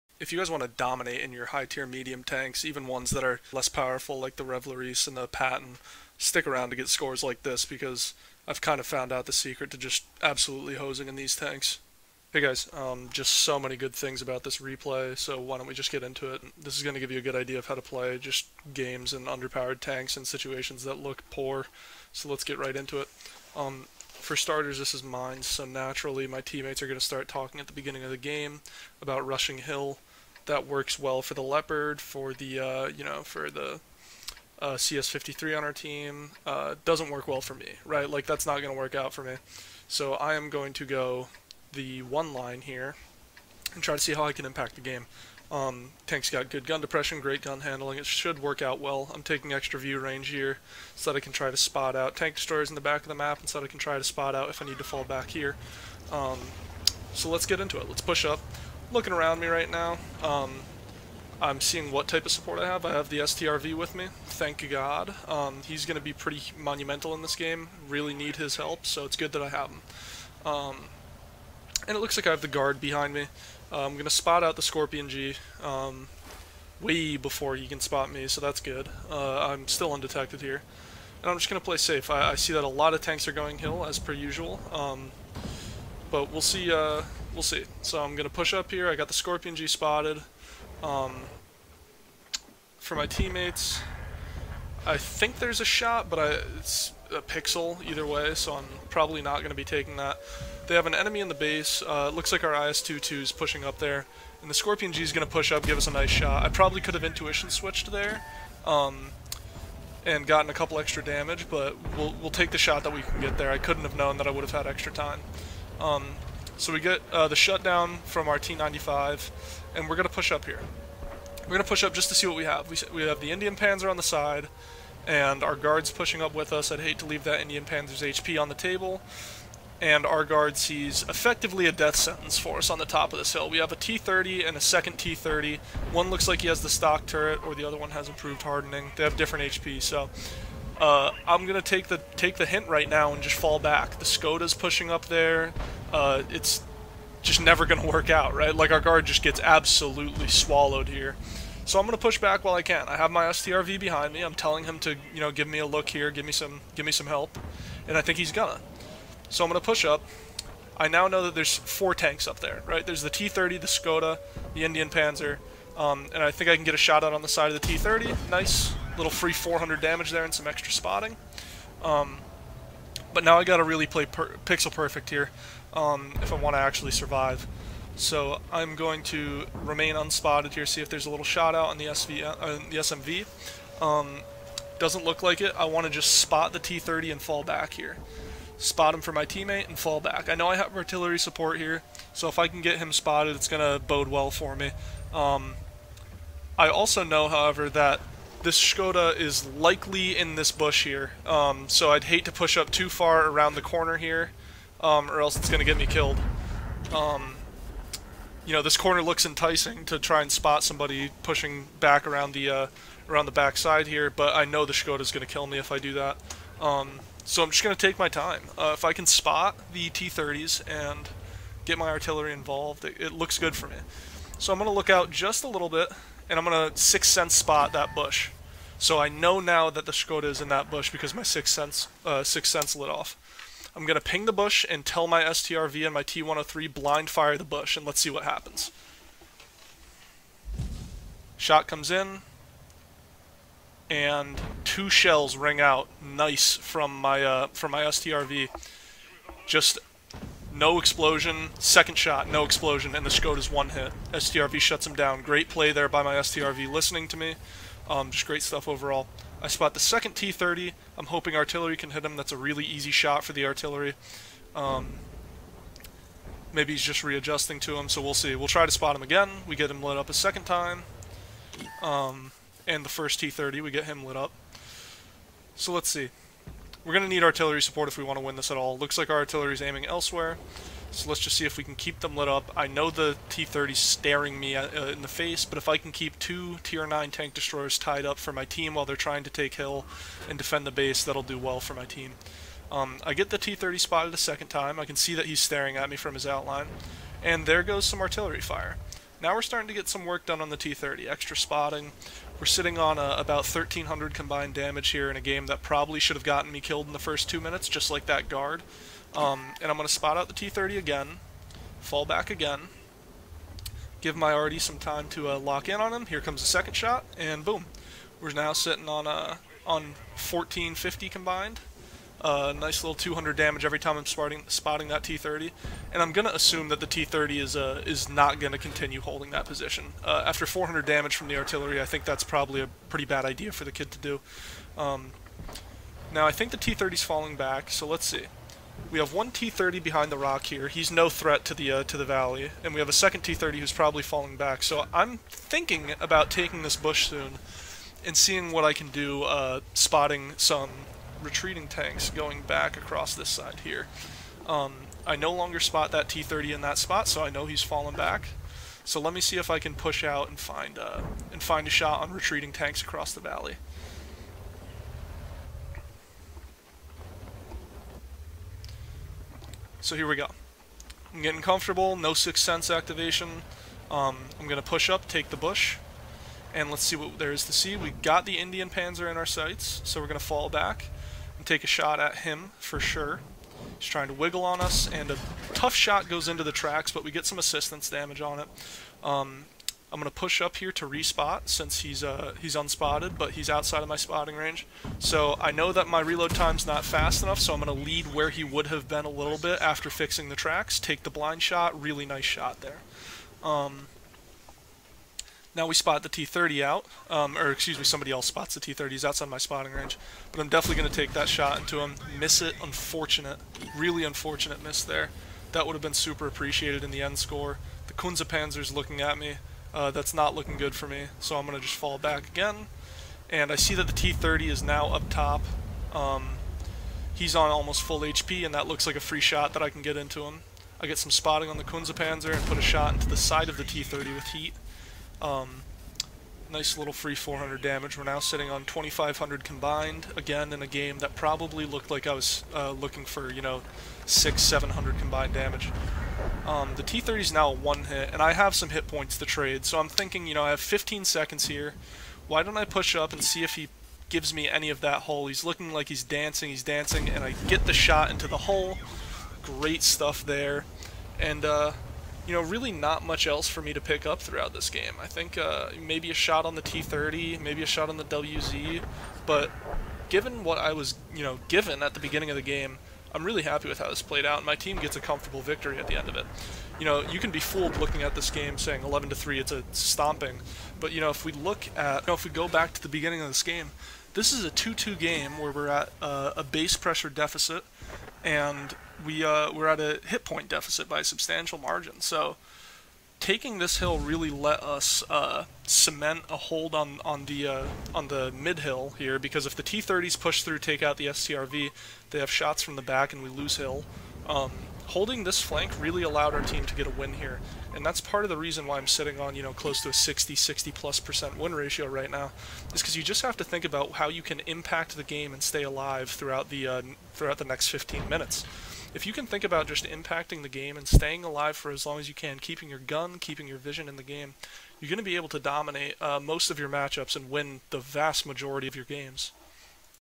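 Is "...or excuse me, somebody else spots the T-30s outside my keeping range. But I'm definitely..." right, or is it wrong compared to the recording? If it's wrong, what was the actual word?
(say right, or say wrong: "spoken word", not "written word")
wrong: "spotting", not "keeping".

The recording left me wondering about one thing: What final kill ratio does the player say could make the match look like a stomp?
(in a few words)
11 to 3.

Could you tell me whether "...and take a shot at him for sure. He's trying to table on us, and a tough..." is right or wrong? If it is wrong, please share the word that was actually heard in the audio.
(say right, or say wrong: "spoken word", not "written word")
wrong: "wiggle", not "table".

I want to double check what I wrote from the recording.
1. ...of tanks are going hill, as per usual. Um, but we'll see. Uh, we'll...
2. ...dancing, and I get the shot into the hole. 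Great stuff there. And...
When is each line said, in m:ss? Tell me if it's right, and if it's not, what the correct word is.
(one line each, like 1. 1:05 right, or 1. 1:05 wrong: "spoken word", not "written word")
1. 1:22 right
2. 7:36 right.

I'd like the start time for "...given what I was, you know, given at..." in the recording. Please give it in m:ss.
7:50.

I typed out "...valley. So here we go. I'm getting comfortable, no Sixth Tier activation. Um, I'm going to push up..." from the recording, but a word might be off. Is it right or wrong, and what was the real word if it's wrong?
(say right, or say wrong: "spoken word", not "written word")
wrong: "Sense", not "Tier".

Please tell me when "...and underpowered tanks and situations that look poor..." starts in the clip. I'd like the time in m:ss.
0:19.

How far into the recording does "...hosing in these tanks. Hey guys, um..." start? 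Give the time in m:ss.
0:10.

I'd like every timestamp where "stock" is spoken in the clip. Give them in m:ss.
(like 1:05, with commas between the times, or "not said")
2:16.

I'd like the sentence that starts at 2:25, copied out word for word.
Uh, it's just never gonna work out, right?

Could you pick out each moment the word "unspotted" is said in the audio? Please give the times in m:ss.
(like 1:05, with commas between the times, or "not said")
2:59, 6:32.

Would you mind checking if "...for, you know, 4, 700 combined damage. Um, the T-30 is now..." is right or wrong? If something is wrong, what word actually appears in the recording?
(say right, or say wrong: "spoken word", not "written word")
wrong: "6", not "4".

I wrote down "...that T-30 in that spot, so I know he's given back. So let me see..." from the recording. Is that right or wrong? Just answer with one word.
wrong.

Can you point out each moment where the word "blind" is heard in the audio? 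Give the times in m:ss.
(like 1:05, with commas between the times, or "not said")
3:56, 6:41.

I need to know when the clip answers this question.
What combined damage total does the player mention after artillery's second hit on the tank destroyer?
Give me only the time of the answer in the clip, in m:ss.
5:20.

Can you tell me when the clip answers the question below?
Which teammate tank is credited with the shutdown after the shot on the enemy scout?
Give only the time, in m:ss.
1:58.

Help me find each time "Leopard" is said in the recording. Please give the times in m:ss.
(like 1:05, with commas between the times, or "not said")
0:31.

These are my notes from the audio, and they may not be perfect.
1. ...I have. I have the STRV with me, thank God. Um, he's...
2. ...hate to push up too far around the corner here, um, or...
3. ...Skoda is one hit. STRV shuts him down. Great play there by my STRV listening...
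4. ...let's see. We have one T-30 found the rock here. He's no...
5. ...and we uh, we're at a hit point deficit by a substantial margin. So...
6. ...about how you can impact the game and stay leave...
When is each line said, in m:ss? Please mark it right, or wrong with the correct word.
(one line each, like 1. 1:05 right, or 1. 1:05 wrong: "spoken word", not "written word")
1. 1:02 right
2. 3:22 right
3. 4:13 right
4. 5:37 wrong: "behind", not "found"
5. 8:08 right
6. 8:33 wrong: "alive", not "leave".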